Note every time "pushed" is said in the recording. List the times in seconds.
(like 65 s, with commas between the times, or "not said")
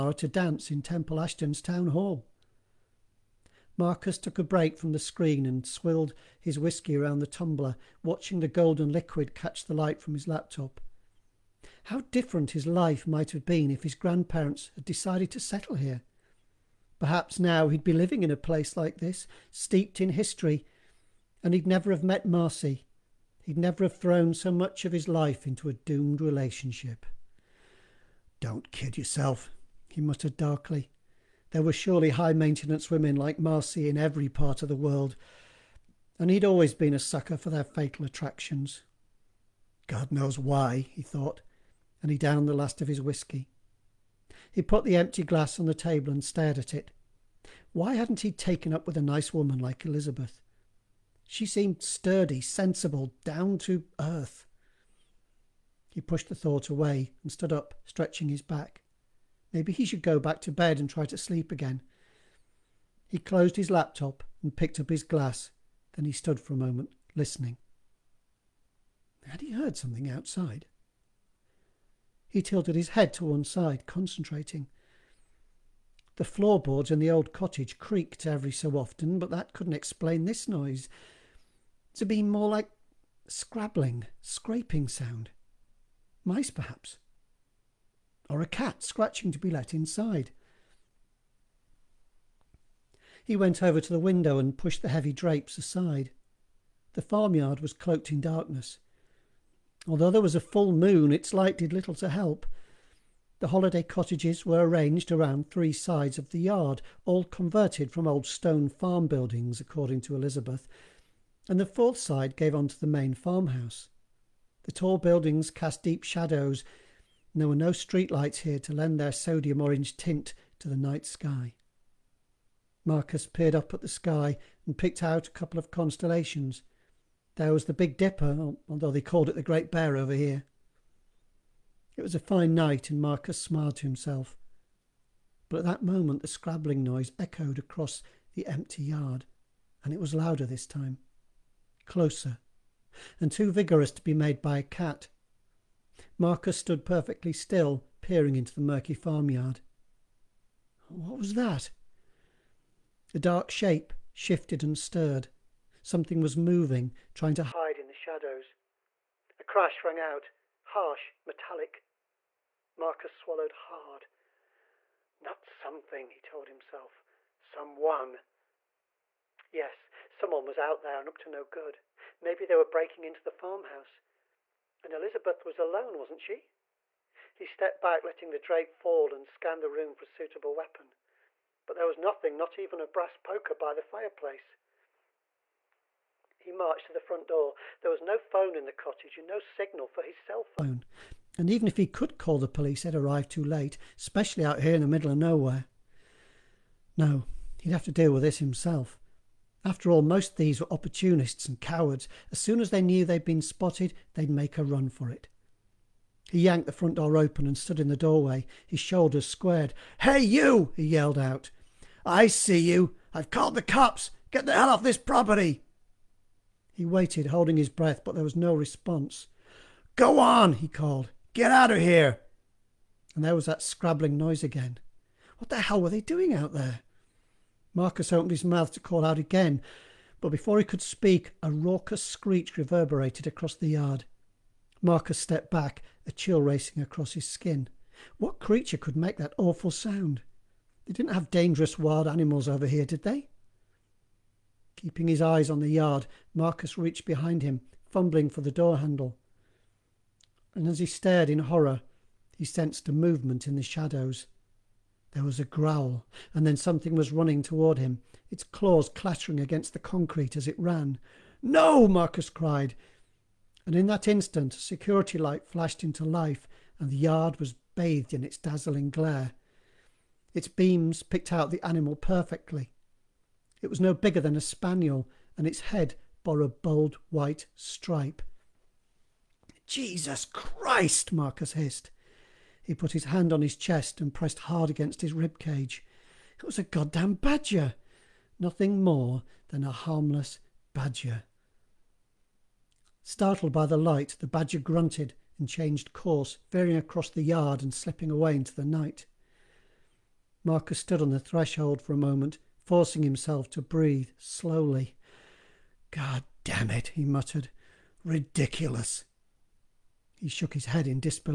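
56 s, 94 s.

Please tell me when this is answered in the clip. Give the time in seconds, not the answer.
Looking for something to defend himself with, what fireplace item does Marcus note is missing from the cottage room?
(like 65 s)
182 s.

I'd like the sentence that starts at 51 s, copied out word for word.
She seemed sturdy, sensible, down to earth.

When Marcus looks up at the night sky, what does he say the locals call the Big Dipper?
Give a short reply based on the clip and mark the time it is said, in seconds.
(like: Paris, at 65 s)
The Great Bear, at 129 s.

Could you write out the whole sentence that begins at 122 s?
Marcus peered up at the sky and picked out a couple of constellations.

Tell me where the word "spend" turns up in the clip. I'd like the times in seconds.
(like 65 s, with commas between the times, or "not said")
not said.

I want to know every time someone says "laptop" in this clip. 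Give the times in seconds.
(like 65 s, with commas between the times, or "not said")
10 s, 63 s.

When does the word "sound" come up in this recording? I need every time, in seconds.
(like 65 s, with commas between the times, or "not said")
84 s, 239 s.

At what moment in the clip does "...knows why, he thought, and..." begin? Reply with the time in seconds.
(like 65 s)
40 s.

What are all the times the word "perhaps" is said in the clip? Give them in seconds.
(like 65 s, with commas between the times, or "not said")
16 s, 86 s.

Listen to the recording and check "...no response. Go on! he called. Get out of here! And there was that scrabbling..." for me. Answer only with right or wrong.
right.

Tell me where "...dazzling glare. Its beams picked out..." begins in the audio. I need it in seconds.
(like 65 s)
268 s.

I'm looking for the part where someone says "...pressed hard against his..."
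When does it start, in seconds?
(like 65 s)
284 s.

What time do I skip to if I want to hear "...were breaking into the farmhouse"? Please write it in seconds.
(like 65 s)
172 s.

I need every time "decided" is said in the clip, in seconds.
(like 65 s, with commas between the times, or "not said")
14 s.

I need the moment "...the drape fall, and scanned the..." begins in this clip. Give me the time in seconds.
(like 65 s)
178 s.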